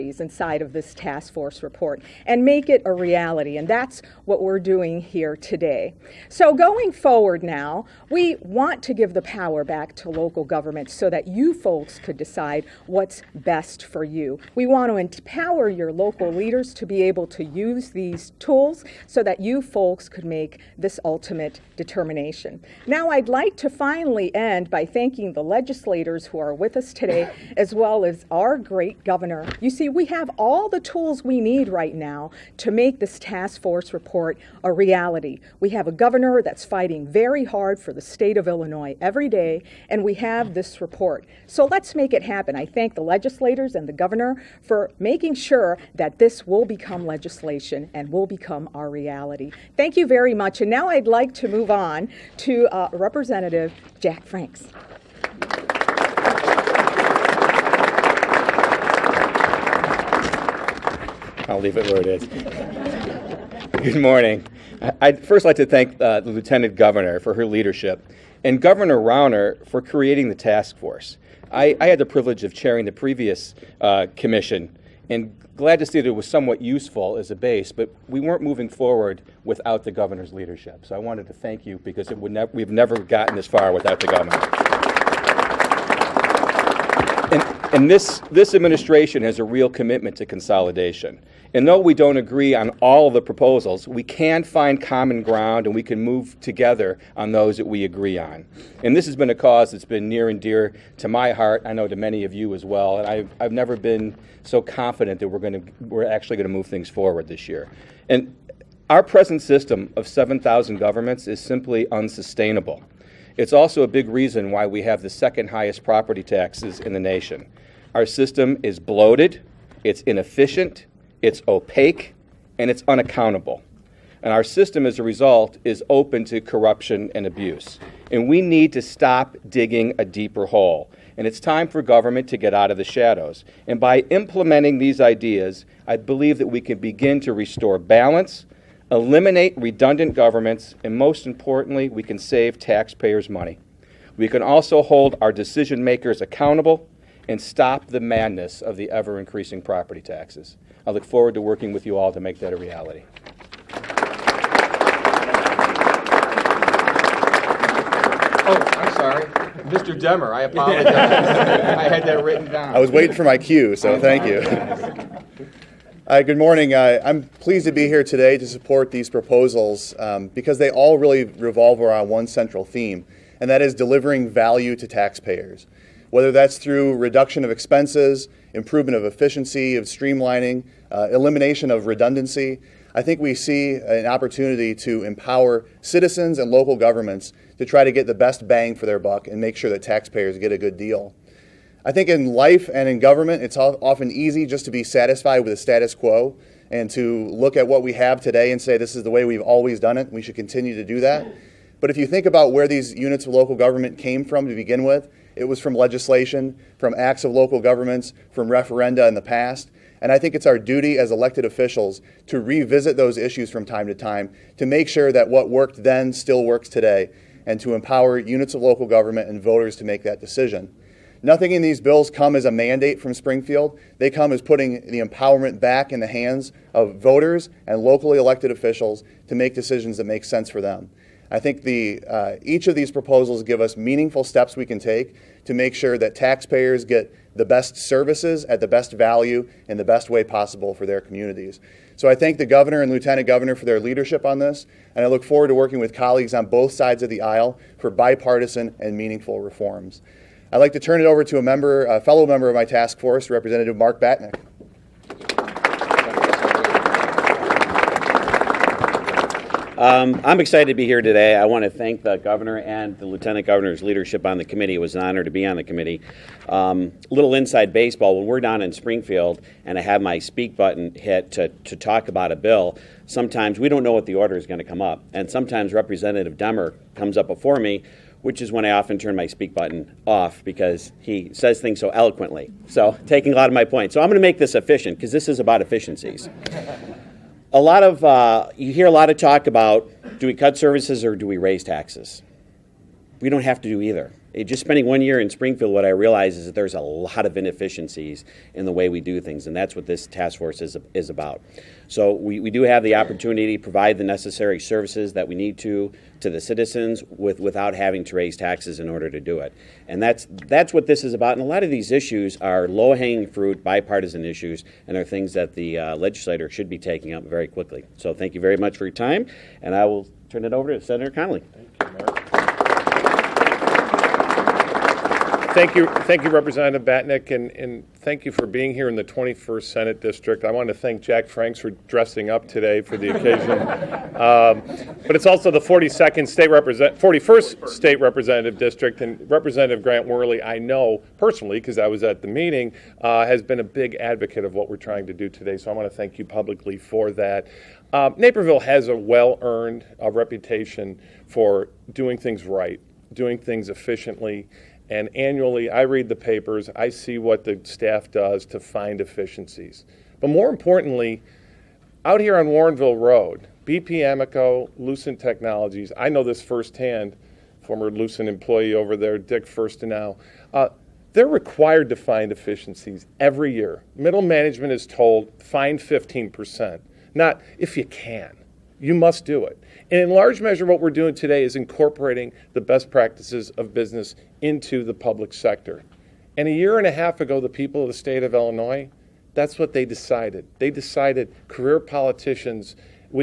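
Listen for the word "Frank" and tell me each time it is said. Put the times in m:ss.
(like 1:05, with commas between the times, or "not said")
0:54, 5:31.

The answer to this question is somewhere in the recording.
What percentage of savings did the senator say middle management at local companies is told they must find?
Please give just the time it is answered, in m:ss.
6:15.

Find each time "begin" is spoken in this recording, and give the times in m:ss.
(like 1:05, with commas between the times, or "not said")
2:16, 3:24.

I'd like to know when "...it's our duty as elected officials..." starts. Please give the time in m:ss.
3:30.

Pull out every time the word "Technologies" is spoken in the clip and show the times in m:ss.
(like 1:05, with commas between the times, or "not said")
6:05.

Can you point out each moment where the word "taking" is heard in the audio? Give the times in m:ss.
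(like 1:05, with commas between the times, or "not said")
4:43, 5:16.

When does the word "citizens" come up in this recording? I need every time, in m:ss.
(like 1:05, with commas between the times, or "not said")
3:05, 5:06.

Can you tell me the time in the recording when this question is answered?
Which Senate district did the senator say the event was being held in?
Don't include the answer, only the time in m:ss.
5:29.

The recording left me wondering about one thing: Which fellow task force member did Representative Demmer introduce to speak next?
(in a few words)
Mark Batinick.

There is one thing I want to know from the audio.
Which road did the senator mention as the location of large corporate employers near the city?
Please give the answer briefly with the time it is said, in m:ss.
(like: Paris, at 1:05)
Warrenville Road, at 6:02.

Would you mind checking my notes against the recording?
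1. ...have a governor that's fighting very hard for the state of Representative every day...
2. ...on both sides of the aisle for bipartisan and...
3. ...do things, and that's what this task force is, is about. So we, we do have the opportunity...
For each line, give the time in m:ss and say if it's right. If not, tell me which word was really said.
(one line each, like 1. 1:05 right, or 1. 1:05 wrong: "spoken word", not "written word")
1. 0:35 wrong: "Illinois", not "Representative"
2. 4:06 right
3. 4:59 right.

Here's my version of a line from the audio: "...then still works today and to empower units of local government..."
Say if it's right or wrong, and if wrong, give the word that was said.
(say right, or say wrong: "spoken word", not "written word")
right.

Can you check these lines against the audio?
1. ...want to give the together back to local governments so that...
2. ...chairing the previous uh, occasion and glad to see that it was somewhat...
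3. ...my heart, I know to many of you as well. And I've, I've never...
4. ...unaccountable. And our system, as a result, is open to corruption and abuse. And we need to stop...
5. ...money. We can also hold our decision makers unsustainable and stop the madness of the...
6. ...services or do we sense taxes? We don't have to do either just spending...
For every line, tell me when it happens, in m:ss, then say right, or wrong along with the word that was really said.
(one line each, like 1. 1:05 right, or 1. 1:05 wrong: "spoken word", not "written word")
1. 0:08 wrong: "power", not "together"
2. 1:12 wrong: "commission", not "occasion"
3. 1:41 right
4. 2:02 right
5. 2:23 wrong: "accountable", not "unsustainable"
6. 4:50 wrong: "raise", not "sense".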